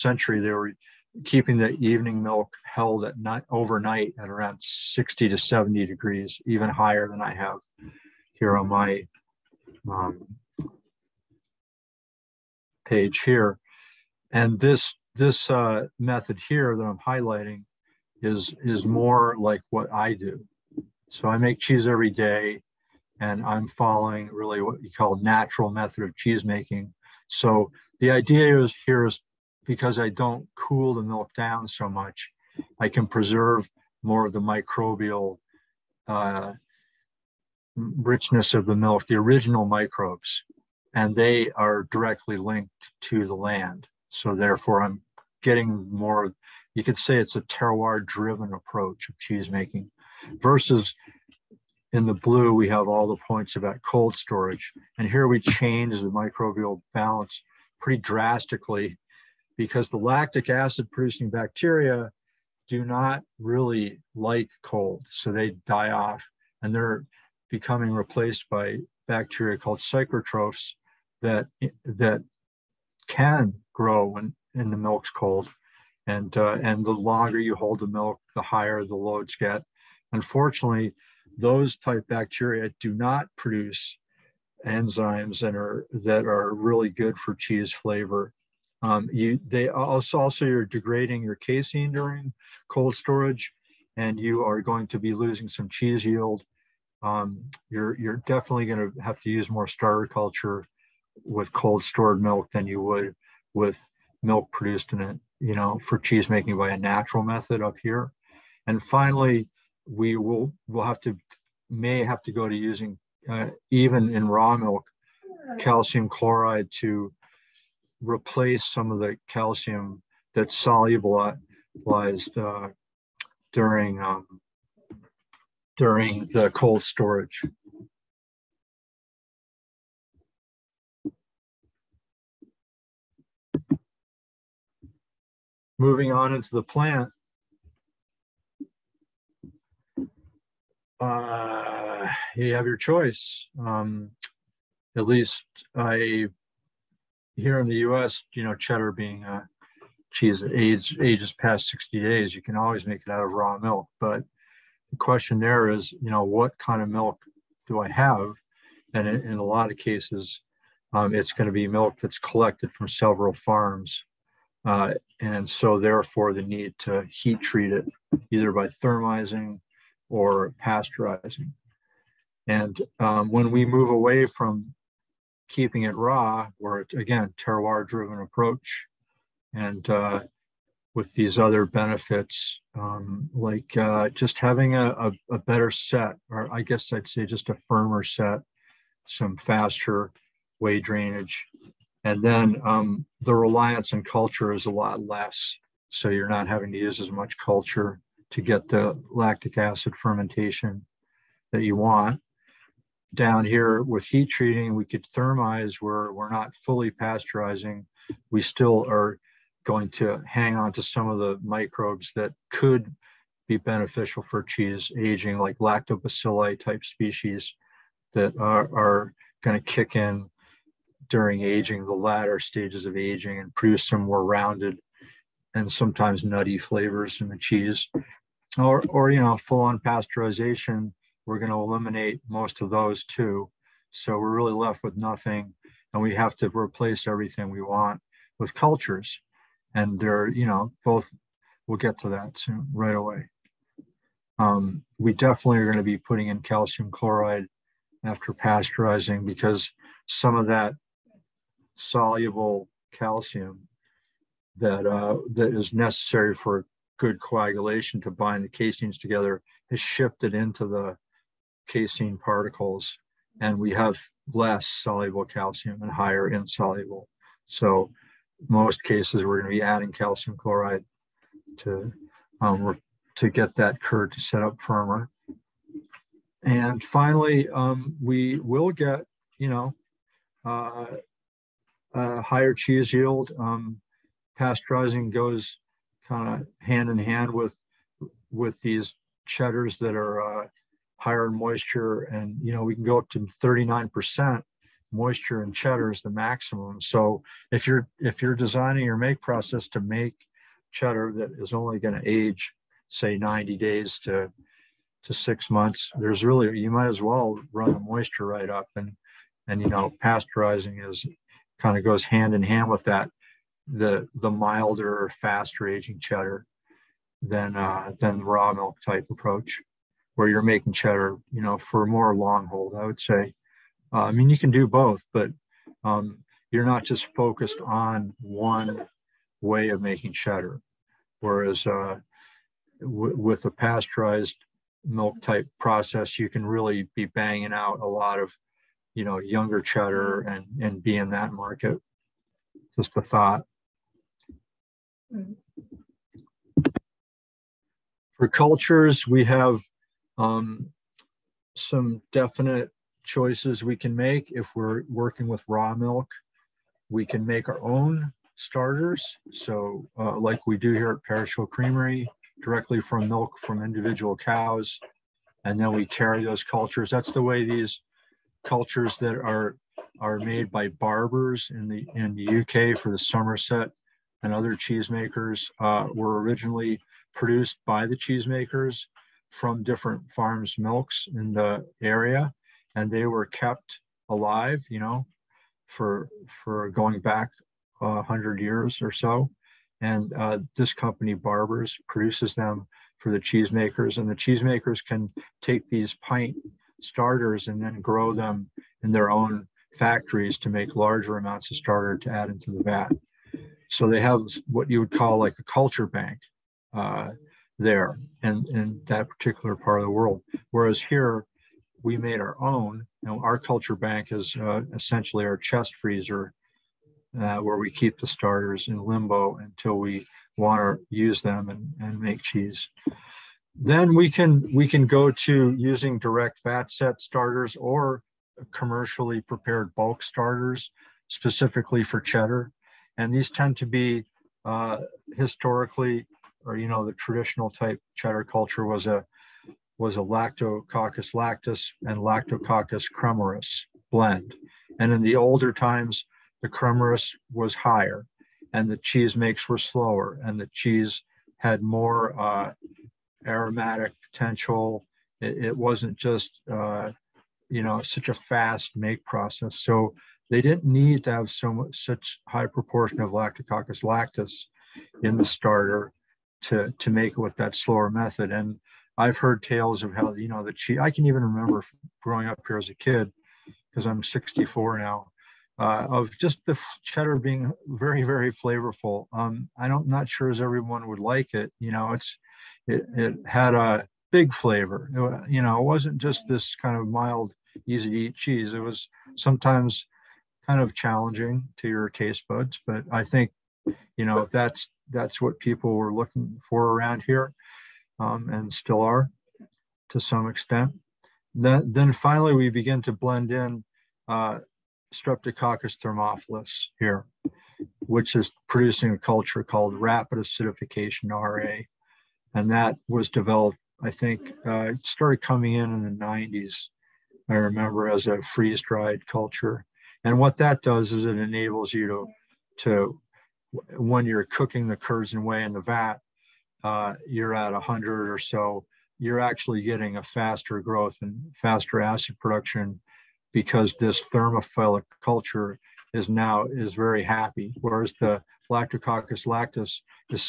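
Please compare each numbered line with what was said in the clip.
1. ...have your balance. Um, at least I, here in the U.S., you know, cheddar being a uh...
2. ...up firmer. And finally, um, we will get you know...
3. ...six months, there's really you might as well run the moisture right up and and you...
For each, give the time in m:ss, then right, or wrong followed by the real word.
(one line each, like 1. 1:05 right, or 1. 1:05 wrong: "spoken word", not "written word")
1. 2:22 wrong: "choice", not "balance"
2. 4:34 right
3. 5:05 right.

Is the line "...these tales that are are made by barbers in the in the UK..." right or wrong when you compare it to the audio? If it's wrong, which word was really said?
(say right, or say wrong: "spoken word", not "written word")
wrong: "cultures", not "tales".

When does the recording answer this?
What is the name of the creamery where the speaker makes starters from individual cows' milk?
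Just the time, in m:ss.
6:01.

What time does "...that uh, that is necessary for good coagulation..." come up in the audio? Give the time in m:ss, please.
4:14.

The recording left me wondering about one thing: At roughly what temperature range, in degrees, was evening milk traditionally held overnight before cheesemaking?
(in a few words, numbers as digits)
60 to 70.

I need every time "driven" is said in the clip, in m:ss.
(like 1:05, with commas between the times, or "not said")
0:47, 2:57.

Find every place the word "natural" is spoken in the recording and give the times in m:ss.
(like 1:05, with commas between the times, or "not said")
0:25, 1:46.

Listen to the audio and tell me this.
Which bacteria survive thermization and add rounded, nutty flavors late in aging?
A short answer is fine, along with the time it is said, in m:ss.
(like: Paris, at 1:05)
lactobacilli, at 3:35.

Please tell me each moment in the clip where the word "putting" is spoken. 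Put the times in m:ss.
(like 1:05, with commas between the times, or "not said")
4:05.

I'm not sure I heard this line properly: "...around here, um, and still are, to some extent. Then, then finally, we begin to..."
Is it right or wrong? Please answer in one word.
right.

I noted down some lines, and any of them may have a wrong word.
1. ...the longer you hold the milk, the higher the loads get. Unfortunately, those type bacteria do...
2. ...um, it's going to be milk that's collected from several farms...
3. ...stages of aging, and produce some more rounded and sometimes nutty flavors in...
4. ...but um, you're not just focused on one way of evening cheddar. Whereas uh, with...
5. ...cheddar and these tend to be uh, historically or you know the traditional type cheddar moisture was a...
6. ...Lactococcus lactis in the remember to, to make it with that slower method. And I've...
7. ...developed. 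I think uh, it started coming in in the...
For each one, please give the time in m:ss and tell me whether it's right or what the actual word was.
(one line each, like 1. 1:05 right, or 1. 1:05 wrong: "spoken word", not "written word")
1. 1:16 right
2. 2:40 right
3. 3:42 right
4. 5:25 wrong: "making", not "evening"
5. 7:11 wrong: "culture", not "moisture"
6. 7:43 wrong: "starter", not "remember"
7. 8:33 right.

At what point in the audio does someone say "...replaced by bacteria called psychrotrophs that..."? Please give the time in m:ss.
1:07.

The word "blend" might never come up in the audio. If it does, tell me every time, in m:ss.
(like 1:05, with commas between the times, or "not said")
7:23, 8:22.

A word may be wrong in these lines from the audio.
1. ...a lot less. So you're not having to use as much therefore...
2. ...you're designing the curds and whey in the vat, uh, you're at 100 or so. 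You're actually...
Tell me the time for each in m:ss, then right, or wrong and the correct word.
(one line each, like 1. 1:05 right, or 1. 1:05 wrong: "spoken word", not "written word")
1. 3:14 wrong: "culture", not "therefore"
2. 8:44 wrong: "cooking", not "designing".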